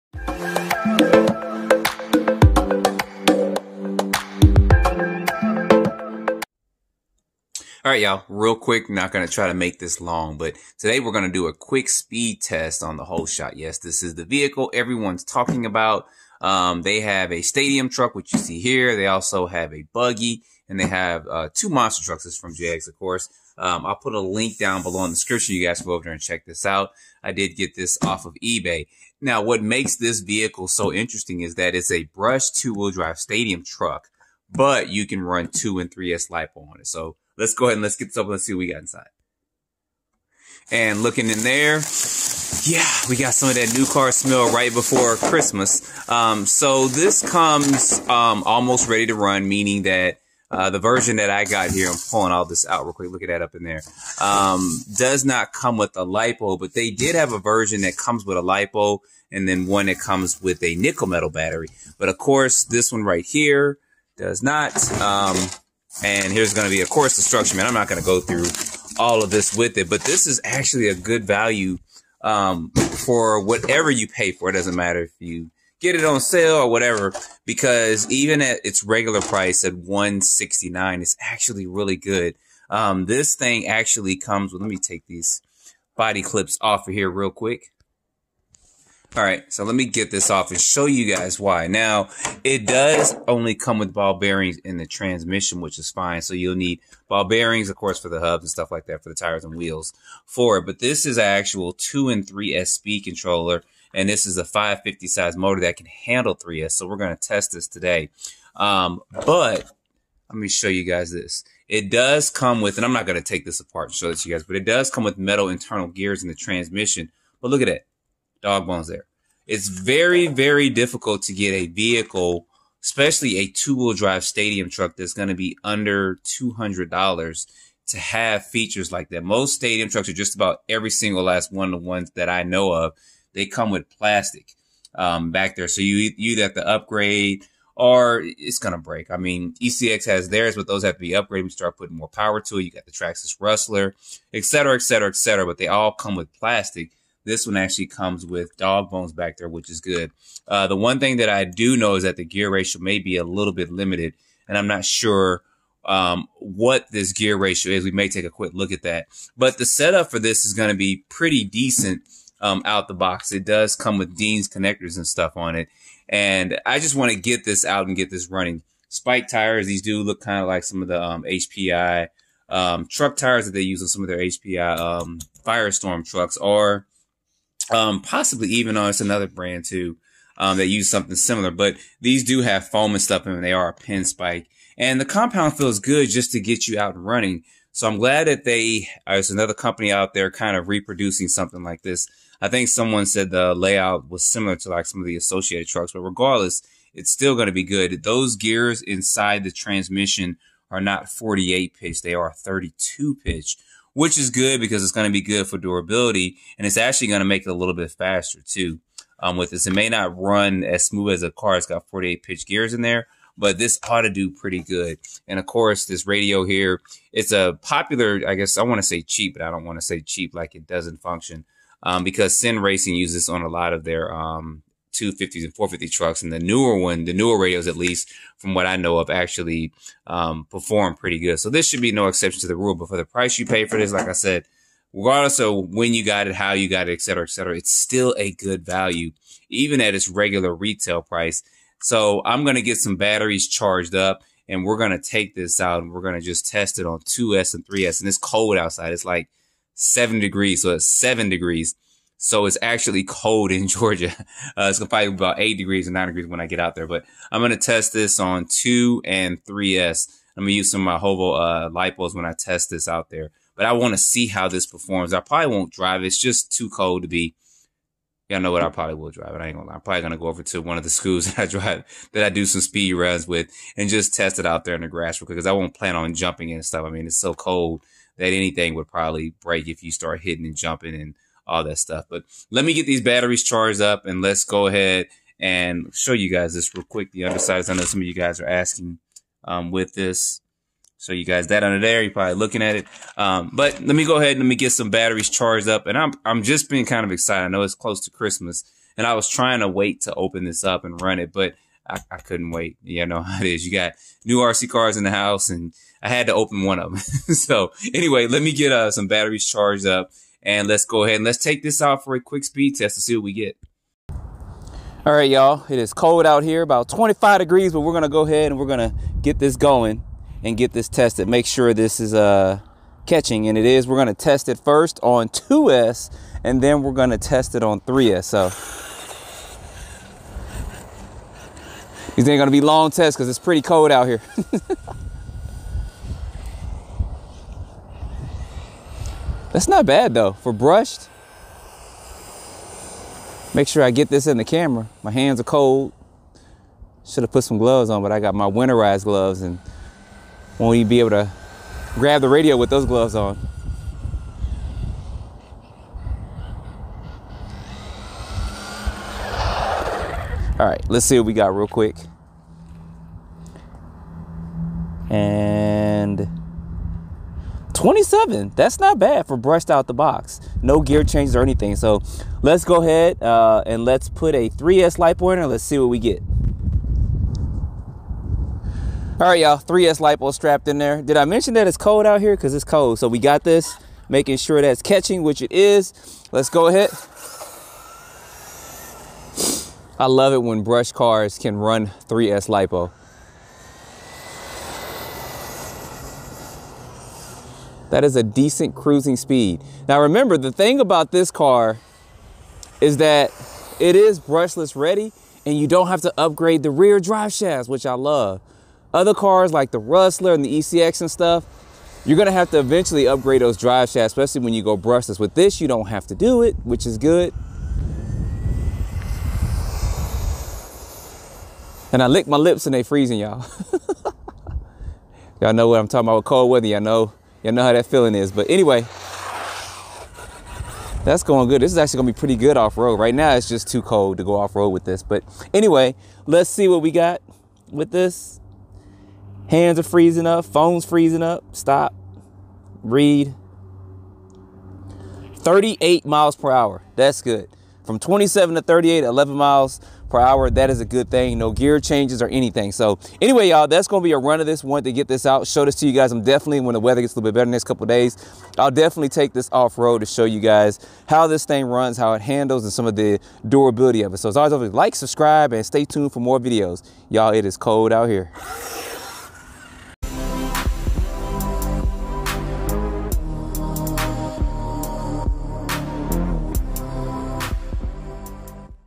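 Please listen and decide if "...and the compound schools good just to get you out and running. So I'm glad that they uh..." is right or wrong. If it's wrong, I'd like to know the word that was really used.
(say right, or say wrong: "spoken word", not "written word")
wrong: "feels", not "schools".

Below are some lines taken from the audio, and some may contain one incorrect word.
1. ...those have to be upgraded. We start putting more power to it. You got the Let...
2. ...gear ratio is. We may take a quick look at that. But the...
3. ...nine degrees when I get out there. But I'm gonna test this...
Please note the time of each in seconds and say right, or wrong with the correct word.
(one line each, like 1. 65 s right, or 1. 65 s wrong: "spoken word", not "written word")
1. 140 s wrong: "Traxxas", not "Let"
2. 157 s right
3. 255 s right.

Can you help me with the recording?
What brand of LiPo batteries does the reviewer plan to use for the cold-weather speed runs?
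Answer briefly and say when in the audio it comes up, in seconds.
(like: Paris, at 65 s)
Hoovo, at 261 s.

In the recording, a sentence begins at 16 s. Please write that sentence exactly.
Um, they have a stadium truck, which you see here.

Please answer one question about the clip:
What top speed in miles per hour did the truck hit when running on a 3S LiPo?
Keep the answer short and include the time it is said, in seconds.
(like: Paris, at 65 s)
38, at 445 s.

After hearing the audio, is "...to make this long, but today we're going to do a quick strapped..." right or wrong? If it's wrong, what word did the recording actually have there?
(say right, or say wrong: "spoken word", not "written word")
wrong: "speed", not "strapped".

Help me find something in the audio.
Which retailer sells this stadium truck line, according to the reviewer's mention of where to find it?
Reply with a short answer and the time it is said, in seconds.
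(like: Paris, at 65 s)
JEGS, at 22 s.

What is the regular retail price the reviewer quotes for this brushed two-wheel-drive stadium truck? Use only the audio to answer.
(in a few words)
169.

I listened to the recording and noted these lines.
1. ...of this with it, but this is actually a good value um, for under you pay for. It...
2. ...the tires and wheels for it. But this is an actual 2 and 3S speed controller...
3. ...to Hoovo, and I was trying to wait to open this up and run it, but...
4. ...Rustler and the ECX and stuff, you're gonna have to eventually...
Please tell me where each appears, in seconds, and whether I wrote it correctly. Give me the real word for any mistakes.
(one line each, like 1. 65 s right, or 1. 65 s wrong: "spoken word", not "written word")
1. 69 s wrong: "whatever", not "under"
2. 99 s right
3. 298 s wrong: "Christmas", not "Hoovo"
4. 409 s right.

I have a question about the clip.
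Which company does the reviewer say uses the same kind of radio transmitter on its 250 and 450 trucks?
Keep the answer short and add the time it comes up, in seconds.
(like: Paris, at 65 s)
Sin Racing, at 222 s.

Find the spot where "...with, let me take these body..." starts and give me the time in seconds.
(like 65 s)
84 s.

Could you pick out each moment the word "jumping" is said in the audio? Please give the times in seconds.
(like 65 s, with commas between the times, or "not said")
276 s, 280 s.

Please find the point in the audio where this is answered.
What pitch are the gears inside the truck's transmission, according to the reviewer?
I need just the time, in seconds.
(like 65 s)
202 s.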